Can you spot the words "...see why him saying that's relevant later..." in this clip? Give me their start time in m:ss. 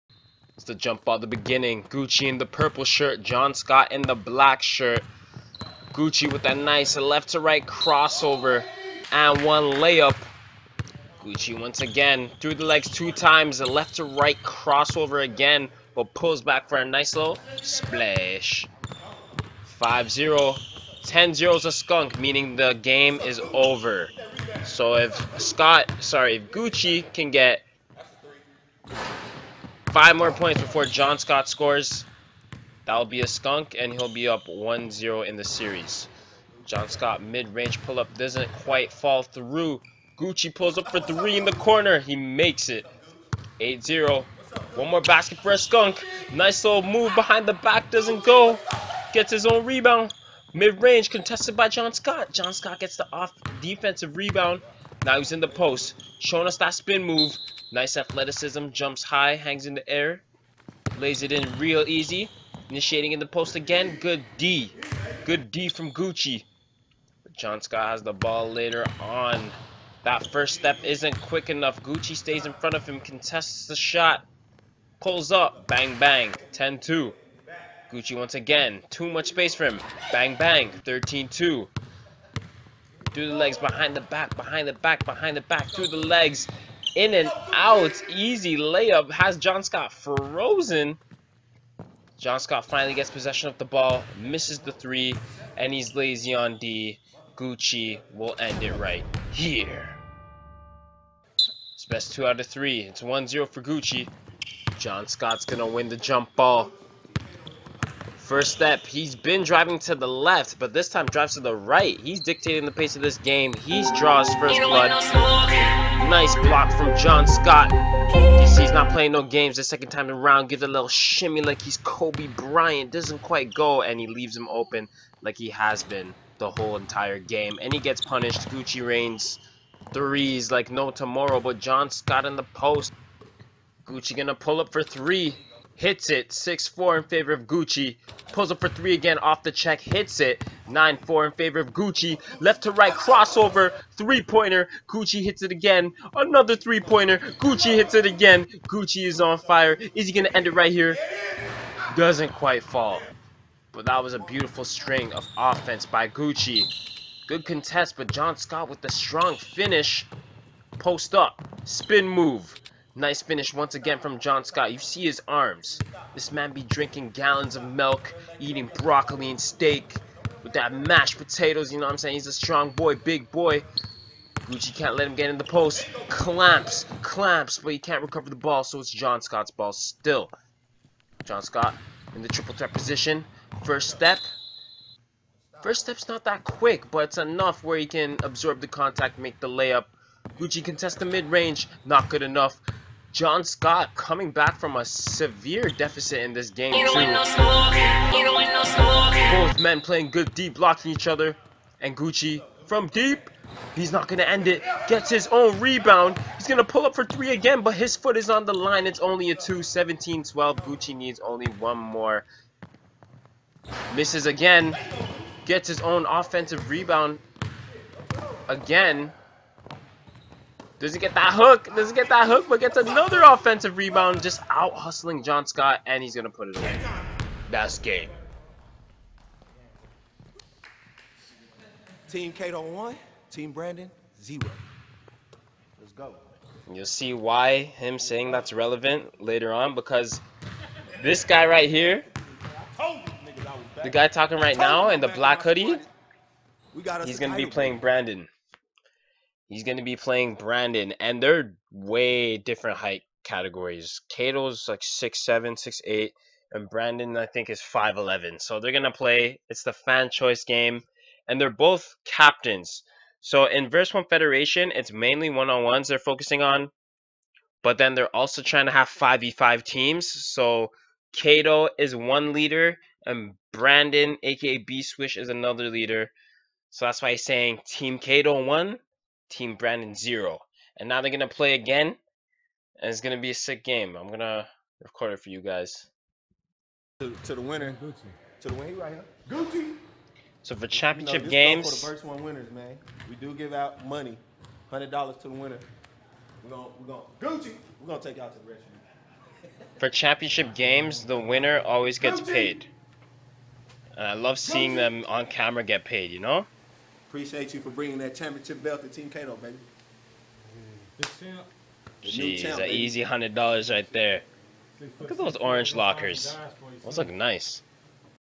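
3:56.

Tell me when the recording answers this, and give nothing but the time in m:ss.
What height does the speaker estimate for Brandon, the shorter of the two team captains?
4:17.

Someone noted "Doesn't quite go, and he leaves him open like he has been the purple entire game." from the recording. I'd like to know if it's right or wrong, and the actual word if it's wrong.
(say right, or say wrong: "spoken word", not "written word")
wrong: "whole", not "purple".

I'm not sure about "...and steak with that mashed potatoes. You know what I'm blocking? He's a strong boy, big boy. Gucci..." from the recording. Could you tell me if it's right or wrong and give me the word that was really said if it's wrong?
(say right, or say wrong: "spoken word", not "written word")
wrong: "saying", not "blocking".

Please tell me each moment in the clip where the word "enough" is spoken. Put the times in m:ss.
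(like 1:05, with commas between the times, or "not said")
1:11, 3:07, 3:12.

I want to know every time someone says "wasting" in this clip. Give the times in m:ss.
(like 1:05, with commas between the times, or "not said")
not said.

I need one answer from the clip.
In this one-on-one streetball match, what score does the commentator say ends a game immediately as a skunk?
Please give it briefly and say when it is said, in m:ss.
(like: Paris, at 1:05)
10-0, at 0:21.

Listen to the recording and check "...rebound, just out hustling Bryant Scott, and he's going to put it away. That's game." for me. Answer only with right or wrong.
wrong.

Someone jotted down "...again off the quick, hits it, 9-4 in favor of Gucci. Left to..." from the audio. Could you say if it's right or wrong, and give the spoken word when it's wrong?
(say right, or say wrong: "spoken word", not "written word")
wrong: "check", not "quick".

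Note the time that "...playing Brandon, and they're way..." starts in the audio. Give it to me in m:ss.
4:09.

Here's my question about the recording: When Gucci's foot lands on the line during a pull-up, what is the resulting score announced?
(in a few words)
17-12.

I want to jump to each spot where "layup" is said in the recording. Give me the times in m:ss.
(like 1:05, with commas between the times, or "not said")
0:09, 1:28, 3:09.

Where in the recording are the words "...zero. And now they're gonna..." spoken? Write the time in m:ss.
4:39.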